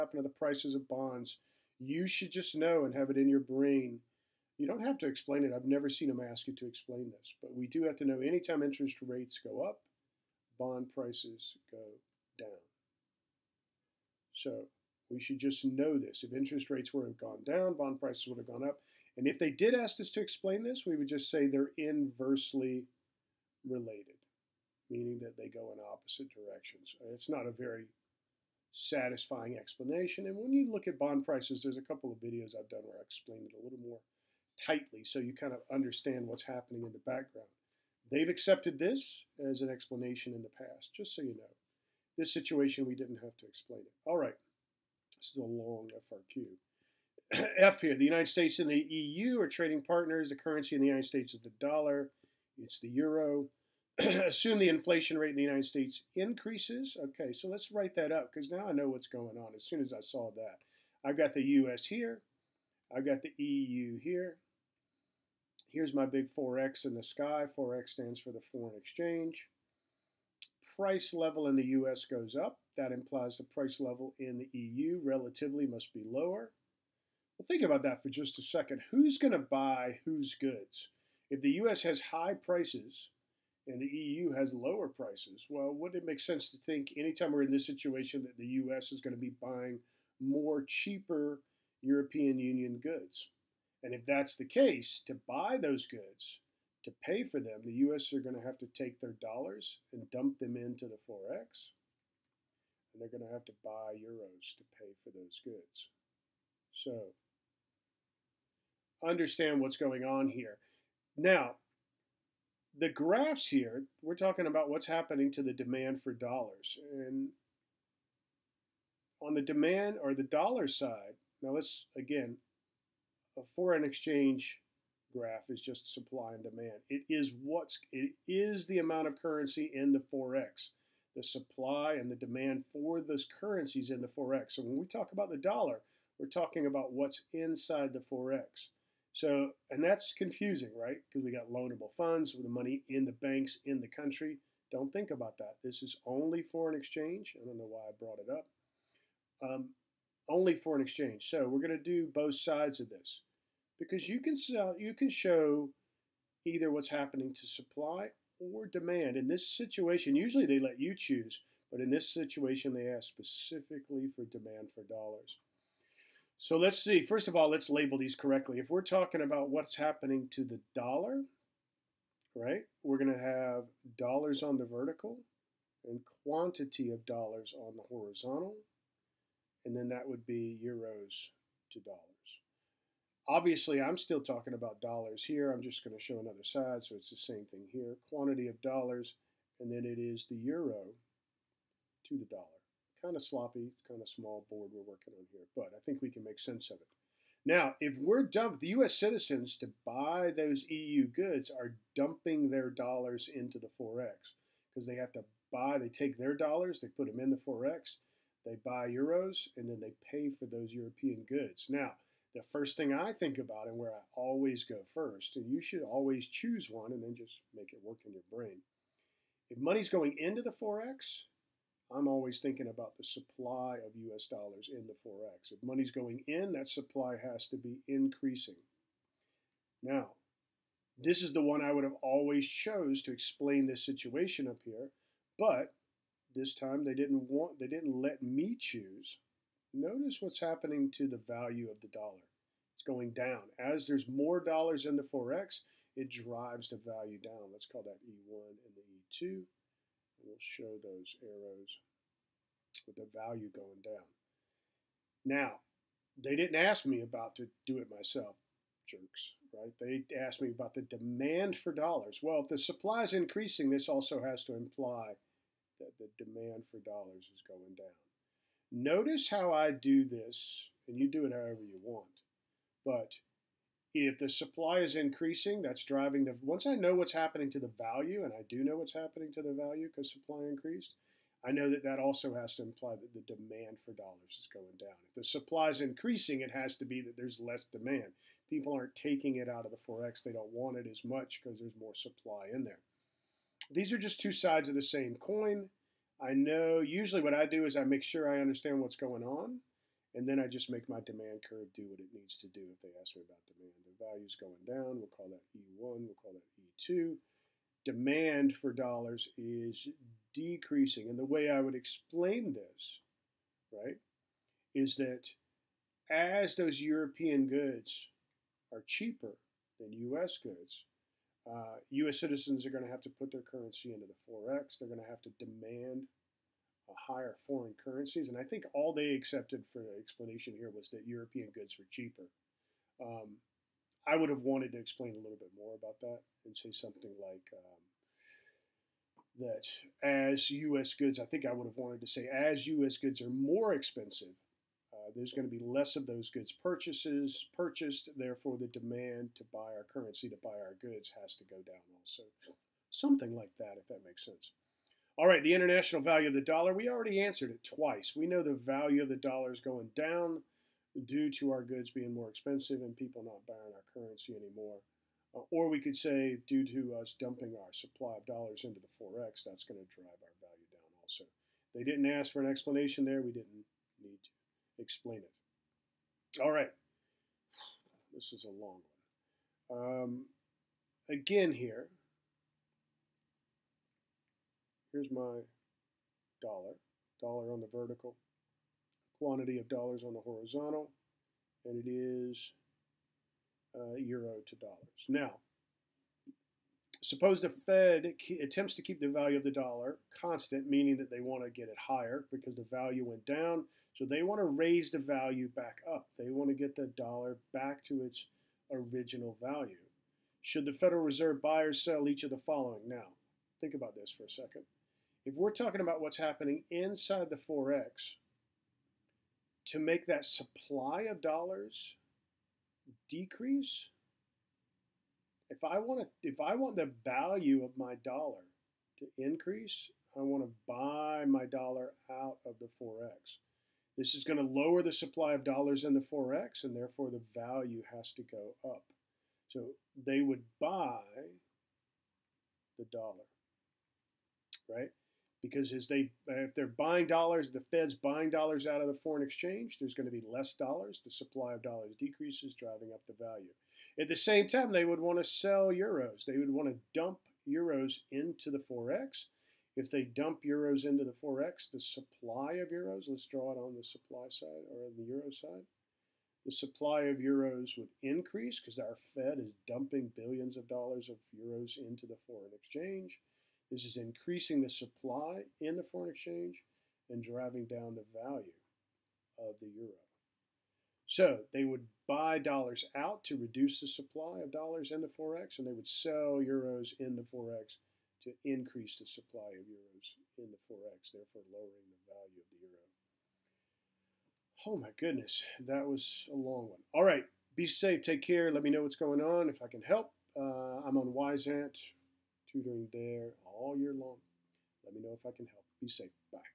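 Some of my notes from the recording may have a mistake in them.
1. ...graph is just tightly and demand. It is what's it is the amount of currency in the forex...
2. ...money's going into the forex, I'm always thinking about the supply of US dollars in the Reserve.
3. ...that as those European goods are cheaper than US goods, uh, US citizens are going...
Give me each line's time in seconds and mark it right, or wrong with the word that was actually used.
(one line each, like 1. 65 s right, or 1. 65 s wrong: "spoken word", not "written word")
1. 125 s wrong: "supply", not "tightly"
2. 219 s wrong: "Forex", not "Reserve"
3. 314 s right.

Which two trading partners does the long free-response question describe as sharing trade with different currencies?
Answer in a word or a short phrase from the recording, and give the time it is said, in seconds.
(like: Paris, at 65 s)
United States and the EU, at 47 s.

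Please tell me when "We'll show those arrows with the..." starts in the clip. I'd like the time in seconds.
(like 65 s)
250 s.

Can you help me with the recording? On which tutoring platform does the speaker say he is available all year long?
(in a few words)
Wyzant.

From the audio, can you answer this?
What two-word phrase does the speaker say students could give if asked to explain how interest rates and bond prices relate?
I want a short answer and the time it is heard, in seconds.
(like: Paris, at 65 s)
inversely related, at 21 s.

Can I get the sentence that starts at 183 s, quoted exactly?
Obviously, I'm still talking about dollars here.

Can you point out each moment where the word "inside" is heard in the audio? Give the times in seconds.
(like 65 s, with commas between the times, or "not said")
137 s, 416 s.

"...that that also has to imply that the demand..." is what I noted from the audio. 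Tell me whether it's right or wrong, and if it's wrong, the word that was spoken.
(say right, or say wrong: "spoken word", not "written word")
right.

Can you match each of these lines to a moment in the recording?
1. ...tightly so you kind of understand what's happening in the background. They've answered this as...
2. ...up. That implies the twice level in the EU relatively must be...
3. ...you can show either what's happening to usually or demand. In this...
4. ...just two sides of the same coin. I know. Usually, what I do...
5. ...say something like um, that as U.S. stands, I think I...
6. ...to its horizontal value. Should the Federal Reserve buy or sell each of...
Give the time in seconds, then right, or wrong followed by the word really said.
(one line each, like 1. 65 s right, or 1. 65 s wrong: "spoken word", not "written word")
1. 34 s wrong: "accepted", not "answered"
2. 72 s wrong: "price", not "twice"
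3. 154 s wrong: "supply", not "usually"
4. 293 s right
5. 336 s wrong: "goods", not "stands"
6. 407 s wrong: "original", not "horizontal".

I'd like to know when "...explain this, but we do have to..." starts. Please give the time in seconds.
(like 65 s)
6 s.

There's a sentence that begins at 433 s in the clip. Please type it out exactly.
This is going to lower the supply of dollars in the forex, and therefore the value has to go up.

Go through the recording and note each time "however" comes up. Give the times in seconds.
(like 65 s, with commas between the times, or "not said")
271 s.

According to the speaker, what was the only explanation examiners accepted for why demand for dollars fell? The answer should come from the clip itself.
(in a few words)
European goods were cheaper.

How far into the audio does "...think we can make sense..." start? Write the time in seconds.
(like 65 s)
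195 s.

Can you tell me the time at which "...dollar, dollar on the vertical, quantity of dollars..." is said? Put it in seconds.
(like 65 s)
386 s.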